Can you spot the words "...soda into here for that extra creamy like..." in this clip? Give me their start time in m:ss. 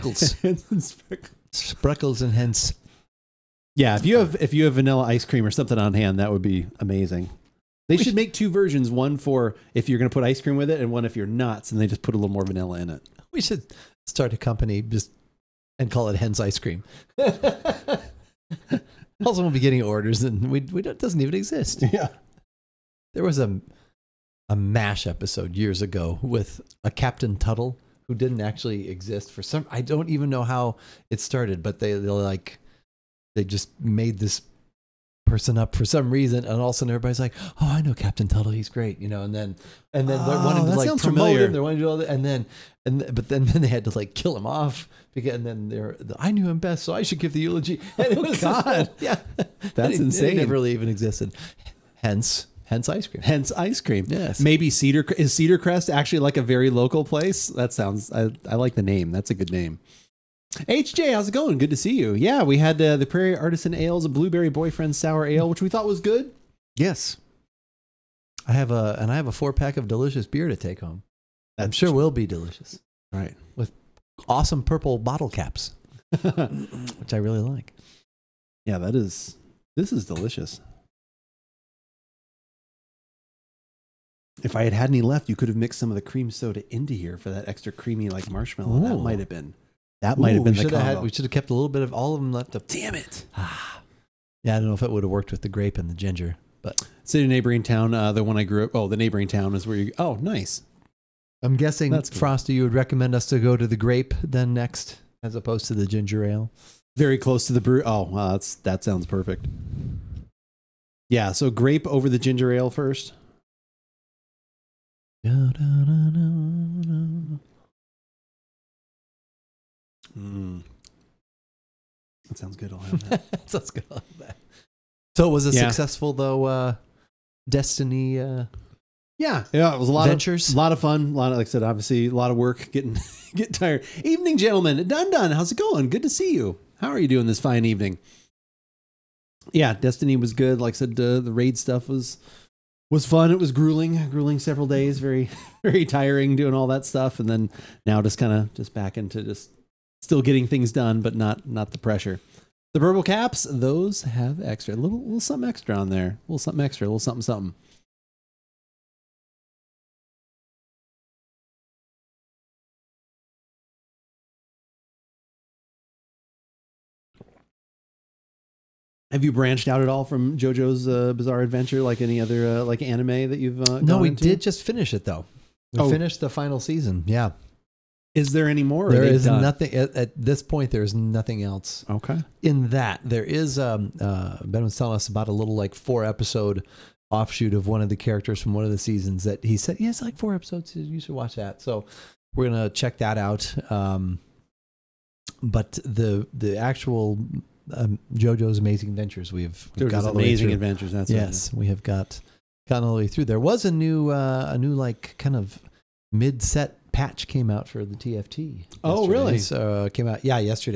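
1:26.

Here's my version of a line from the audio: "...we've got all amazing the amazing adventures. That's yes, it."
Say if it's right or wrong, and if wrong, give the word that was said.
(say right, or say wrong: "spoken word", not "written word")
right.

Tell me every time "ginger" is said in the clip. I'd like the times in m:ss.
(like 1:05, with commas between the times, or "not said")
1:35, 1:45, 1:52.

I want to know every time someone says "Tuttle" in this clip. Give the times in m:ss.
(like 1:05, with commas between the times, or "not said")
0:27, 0:38.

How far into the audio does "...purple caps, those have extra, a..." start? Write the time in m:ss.
2:32.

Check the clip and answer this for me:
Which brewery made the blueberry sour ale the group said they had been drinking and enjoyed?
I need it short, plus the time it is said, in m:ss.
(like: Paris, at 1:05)
Prairie Artisan Ales, at 1:03.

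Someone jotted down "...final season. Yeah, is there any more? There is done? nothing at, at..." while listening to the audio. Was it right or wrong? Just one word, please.
right.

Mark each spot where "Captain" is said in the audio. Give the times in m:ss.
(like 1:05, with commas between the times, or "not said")
0:26, 0:37.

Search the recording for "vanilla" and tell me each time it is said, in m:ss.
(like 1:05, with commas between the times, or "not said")
0:04, 0:12.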